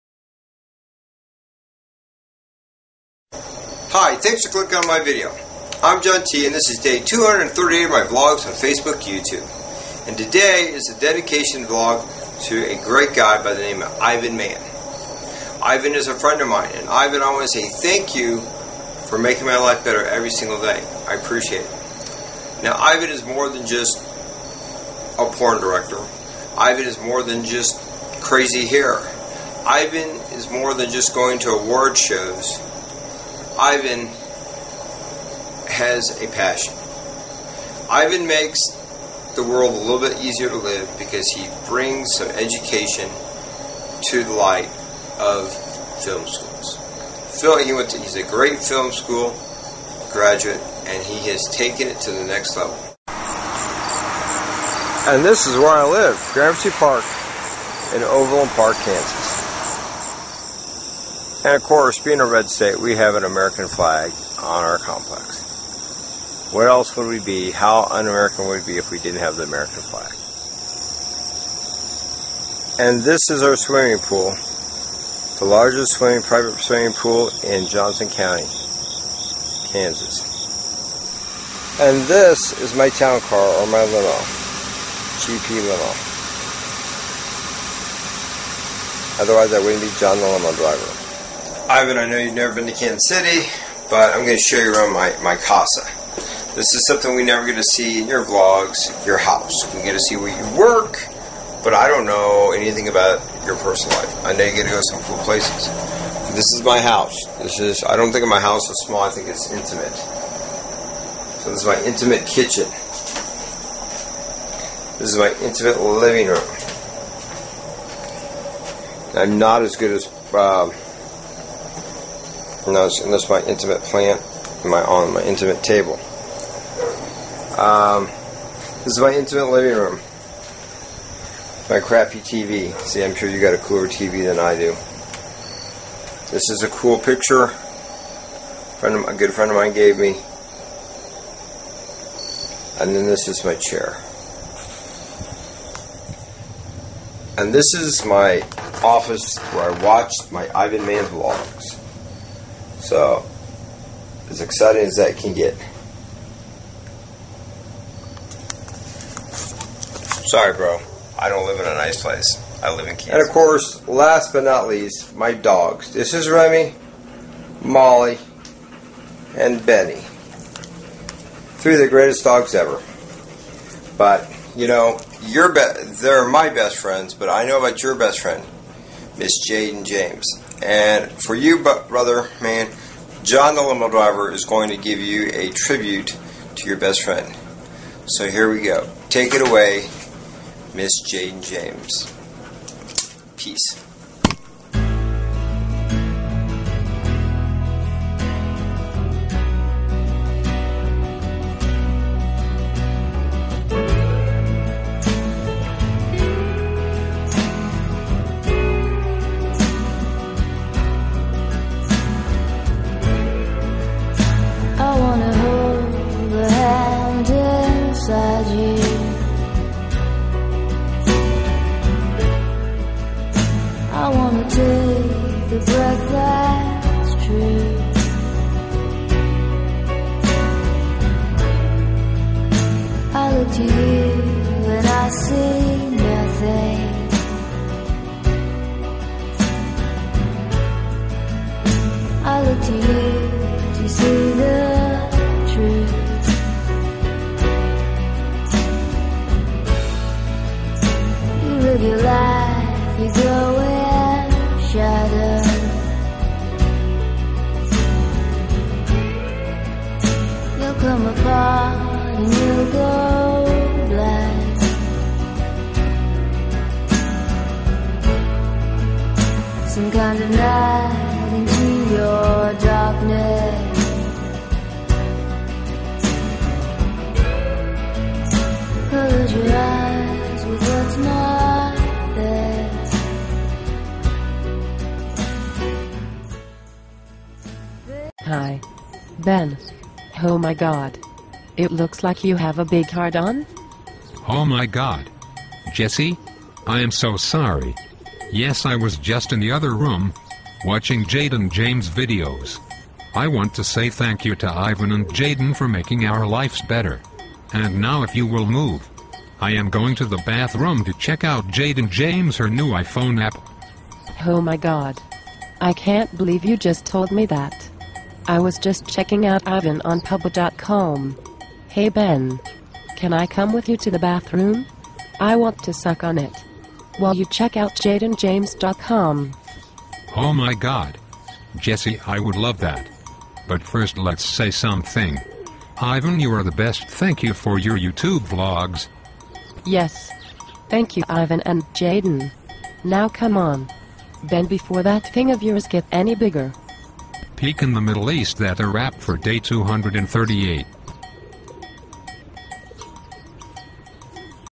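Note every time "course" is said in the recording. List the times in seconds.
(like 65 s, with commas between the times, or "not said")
61 s, 163 s.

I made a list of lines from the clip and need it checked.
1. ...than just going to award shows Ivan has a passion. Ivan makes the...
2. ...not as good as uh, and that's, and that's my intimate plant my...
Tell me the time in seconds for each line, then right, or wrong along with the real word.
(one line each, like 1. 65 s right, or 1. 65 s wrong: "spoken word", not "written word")
1. 30 s right
2. 119 s right.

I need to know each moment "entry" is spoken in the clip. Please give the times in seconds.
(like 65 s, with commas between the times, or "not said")
not said.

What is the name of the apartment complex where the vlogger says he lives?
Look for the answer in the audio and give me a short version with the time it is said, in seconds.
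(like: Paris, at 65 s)
Gramercy Park, at 56 s.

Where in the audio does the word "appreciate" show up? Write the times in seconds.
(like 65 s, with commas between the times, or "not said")
21 s.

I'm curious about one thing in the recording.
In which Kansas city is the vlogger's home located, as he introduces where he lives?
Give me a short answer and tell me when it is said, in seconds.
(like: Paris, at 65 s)
Overland Park, at 58 s.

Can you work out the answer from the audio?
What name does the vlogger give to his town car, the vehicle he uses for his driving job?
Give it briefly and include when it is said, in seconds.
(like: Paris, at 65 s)
GP limo, at 85 s.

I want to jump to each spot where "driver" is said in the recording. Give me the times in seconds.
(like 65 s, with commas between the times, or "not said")
90 s, 183 s.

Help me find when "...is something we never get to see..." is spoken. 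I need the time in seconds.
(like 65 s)
96 s.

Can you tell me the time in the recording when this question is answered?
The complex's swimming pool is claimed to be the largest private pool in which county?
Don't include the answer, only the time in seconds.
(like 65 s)
77 s.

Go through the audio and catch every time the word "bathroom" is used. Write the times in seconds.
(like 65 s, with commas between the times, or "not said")
310 s, 323 s.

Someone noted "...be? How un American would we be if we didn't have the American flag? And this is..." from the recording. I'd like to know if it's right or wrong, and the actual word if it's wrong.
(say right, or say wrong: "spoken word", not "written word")
right.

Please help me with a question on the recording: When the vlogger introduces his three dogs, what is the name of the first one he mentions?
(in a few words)
Remy.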